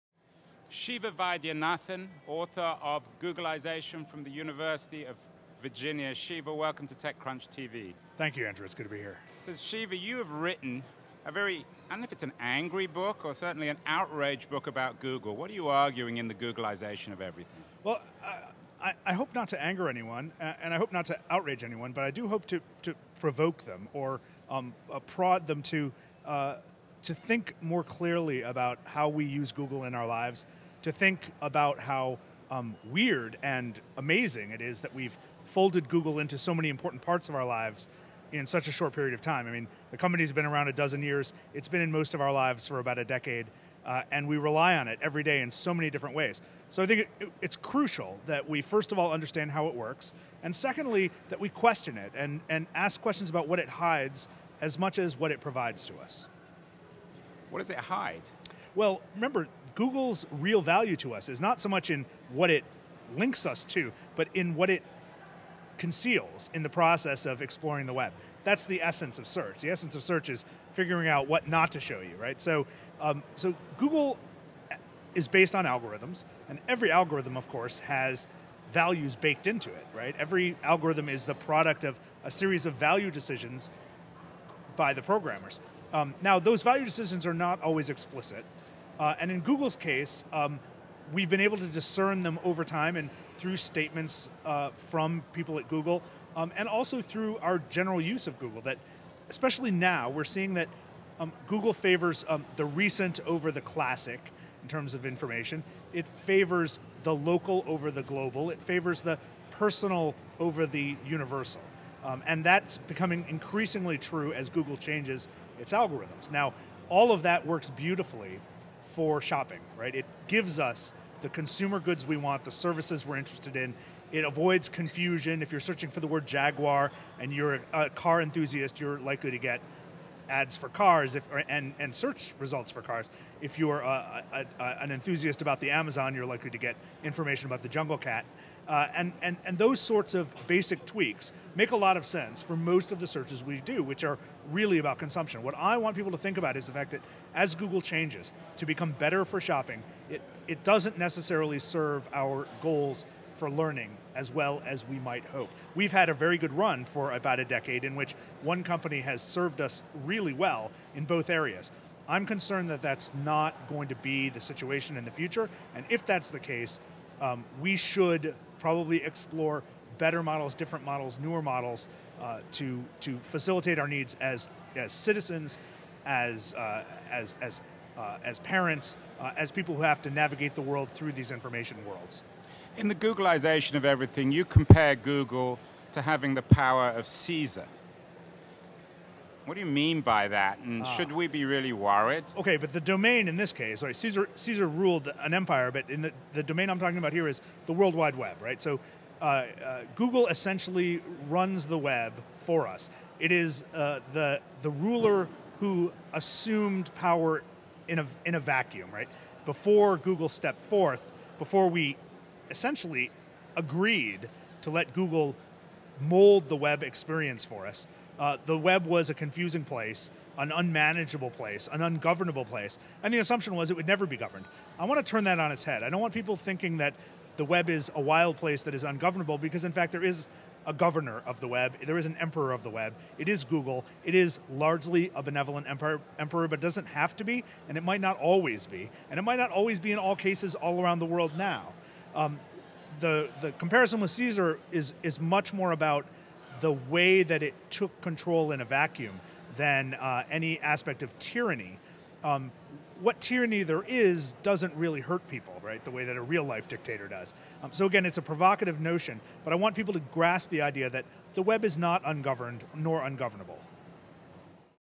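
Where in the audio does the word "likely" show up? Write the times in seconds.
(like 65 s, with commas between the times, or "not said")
128 s, 136 s.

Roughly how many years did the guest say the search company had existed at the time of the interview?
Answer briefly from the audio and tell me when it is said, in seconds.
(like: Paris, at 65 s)
a dozen years, at 40 s.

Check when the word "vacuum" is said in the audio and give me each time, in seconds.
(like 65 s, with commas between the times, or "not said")
208 s, 248 s.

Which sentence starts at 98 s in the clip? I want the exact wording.
That, especially now, we're seeing that um, Google favors um, the recent over the classic in terms of information.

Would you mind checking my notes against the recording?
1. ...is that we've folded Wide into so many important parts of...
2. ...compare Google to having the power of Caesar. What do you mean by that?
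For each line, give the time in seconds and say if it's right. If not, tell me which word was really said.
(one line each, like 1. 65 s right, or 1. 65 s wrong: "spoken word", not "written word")
1. 34 s wrong: "Google", not "Wide"
2. 184 s right.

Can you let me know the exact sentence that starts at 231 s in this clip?
There is an emperor of the web.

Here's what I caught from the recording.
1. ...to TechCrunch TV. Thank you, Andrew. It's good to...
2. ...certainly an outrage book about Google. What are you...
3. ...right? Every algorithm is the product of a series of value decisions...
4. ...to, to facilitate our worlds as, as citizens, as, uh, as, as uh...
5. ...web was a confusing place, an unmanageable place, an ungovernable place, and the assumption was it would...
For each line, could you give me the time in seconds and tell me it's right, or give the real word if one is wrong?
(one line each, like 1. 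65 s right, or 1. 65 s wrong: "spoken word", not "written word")
1. 6 s right
2. 13 s right
3. 79 s right
4. 172 s wrong: "needs", not "worlds"
5. 218 s right.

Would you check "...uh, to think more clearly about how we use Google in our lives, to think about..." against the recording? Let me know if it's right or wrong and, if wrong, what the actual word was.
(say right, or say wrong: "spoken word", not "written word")
right.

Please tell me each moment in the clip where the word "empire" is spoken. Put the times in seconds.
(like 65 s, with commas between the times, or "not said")
195 s.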